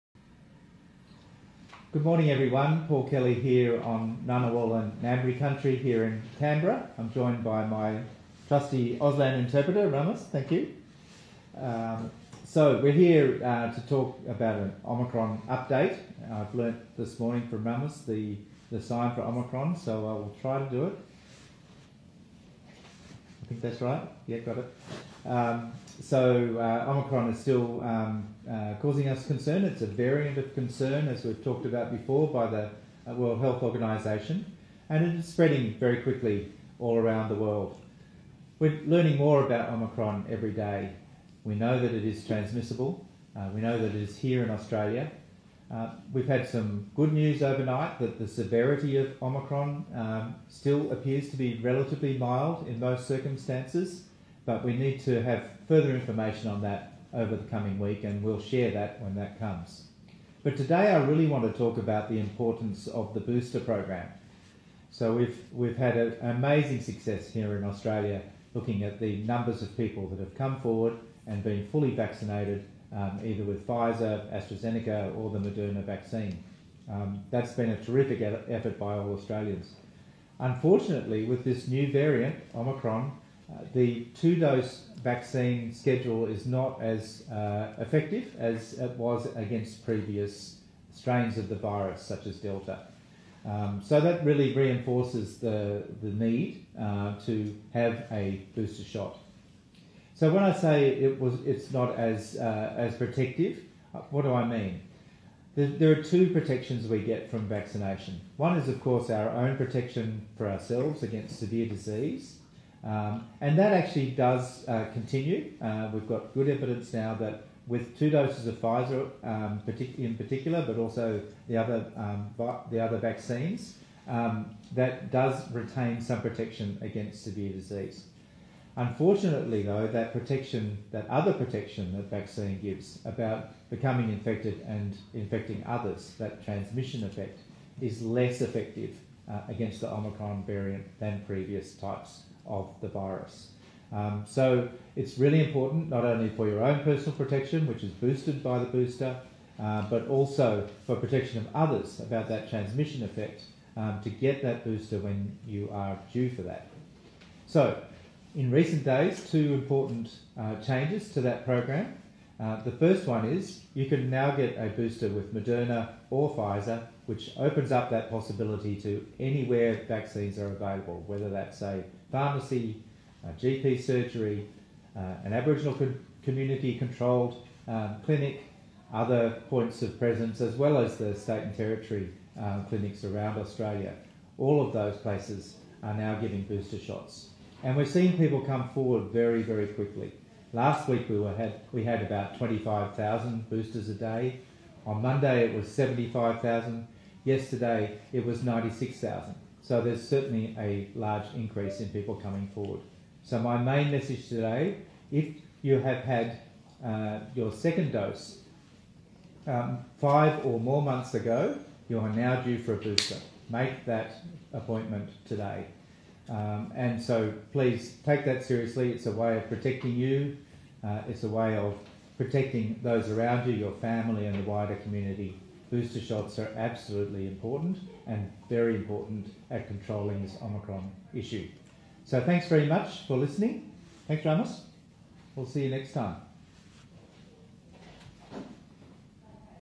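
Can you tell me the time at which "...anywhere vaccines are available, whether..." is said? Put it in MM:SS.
02:49.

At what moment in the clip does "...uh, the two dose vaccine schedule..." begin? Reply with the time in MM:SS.
01:23.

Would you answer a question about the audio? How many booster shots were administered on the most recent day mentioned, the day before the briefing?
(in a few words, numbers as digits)
96,000.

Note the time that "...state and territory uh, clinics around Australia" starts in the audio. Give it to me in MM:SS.
03:01.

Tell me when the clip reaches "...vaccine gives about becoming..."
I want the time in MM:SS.
02:12.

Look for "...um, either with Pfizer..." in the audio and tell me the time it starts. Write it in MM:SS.
01:12.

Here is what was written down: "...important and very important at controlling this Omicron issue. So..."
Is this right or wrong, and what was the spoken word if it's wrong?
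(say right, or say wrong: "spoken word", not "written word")
right.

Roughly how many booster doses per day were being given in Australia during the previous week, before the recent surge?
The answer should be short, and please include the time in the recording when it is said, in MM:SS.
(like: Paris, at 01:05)
25,000, at 03:12.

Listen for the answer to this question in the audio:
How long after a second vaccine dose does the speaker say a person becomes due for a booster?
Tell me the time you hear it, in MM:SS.
03:29.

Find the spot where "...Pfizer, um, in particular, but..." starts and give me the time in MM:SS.
01:58.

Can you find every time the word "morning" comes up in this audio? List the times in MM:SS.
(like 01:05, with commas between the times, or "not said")
00:02, 00:17.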